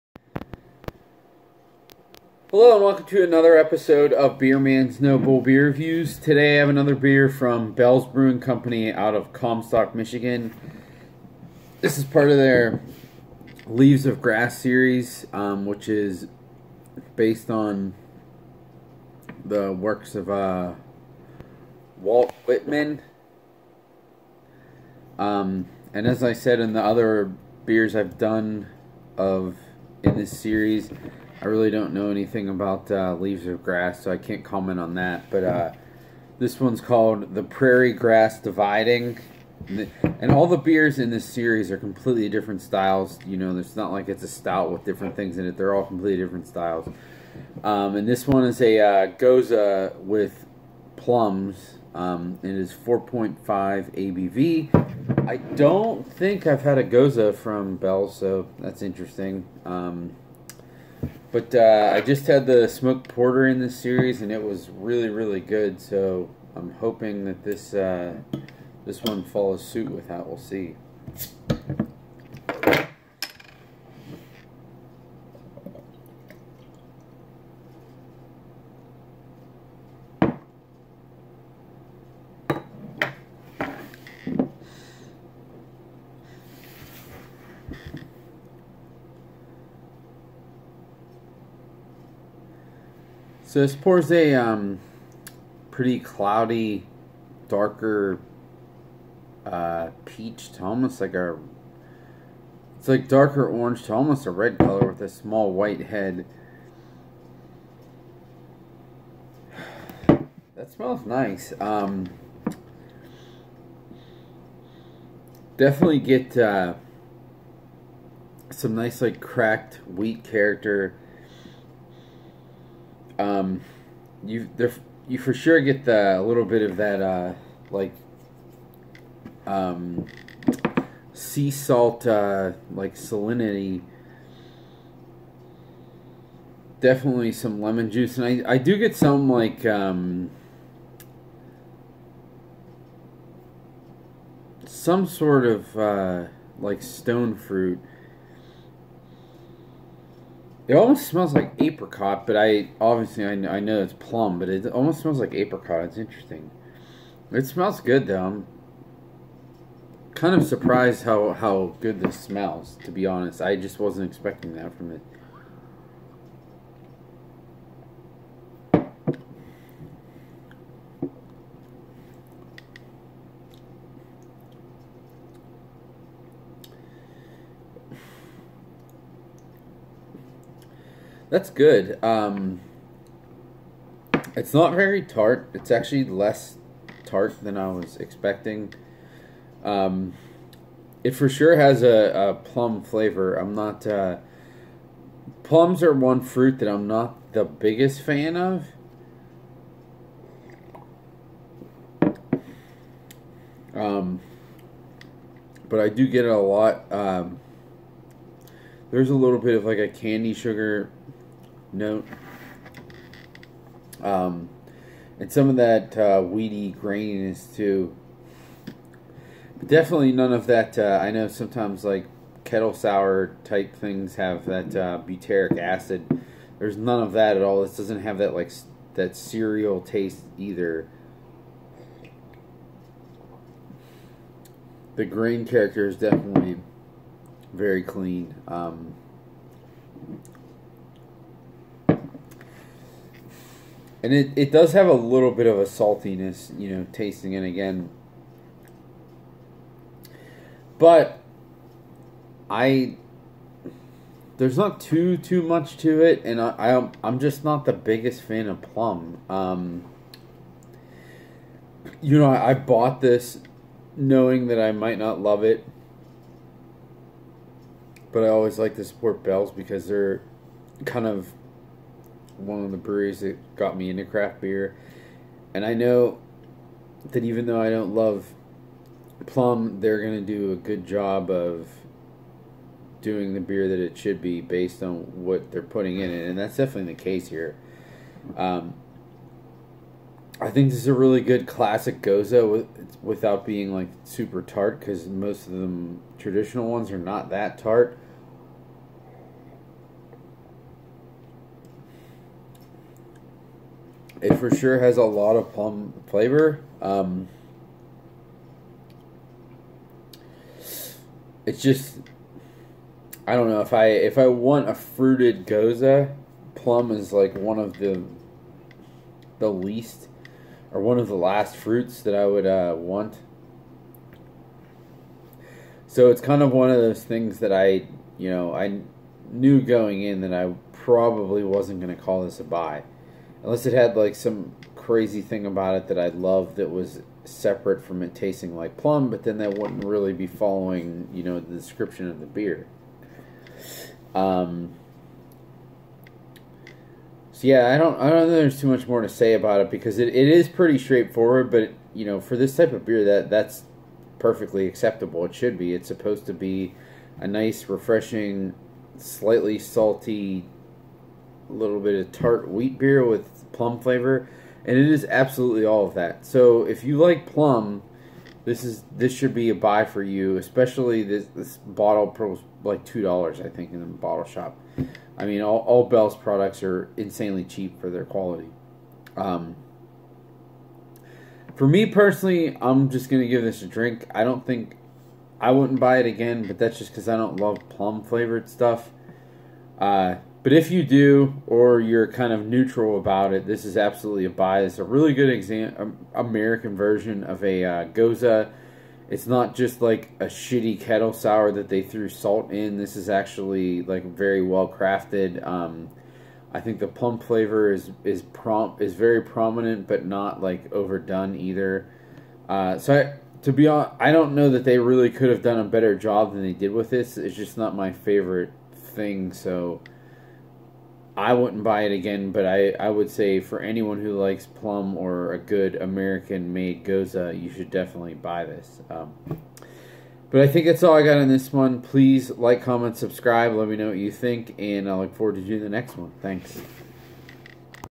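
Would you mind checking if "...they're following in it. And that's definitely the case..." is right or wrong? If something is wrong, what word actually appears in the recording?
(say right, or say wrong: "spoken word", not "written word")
wrong: "putting", not "following".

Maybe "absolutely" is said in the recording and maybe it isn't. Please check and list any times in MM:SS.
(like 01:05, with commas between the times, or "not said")
06:05, 06:33.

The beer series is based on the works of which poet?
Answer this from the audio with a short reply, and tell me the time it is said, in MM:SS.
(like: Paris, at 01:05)
Walt Whitman, at 00:22.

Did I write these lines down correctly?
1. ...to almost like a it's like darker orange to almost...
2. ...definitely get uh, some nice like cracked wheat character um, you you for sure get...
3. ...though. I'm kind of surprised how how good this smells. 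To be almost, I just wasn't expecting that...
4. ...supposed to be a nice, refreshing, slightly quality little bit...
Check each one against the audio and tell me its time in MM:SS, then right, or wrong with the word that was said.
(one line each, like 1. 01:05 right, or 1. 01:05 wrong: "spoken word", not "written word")
1. 01:40 right
2. 01:55 right
3. 02:38 wrong: "honest", not "almost"
4. 05:55 wrong: "salty", not "quality".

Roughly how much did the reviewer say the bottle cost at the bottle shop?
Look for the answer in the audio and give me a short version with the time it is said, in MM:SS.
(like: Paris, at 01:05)
$2, at 06:12.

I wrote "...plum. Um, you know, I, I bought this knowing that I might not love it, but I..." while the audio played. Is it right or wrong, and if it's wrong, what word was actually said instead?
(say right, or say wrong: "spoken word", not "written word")
right.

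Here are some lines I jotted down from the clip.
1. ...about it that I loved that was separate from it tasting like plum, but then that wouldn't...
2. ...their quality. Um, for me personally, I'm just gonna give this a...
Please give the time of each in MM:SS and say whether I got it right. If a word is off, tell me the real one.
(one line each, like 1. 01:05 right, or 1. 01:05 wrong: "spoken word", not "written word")
1. 05:35 right
2. 06:17 right.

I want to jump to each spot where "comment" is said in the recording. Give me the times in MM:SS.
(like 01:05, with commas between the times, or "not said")
00:34, 07:12.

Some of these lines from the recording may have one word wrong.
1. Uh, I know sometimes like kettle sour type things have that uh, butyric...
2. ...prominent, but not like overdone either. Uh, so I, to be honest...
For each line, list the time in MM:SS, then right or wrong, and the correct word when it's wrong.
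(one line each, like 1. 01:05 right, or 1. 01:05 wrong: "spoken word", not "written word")
1. 03:40 right
2. 06:49 right.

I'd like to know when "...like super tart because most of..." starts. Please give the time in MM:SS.
04:53.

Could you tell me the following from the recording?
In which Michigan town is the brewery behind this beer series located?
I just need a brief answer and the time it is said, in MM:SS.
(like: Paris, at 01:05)
Comstock, at 00:09.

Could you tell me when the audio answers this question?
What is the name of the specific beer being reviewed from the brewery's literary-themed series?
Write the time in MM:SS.
00:37.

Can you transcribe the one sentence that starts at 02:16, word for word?
Definitely some lemon juice, and I I do get some like um, some sort of uh, like stone fruit.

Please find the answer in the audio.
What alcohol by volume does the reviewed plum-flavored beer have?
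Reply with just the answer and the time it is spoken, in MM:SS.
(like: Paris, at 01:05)
4.5, at 00:52.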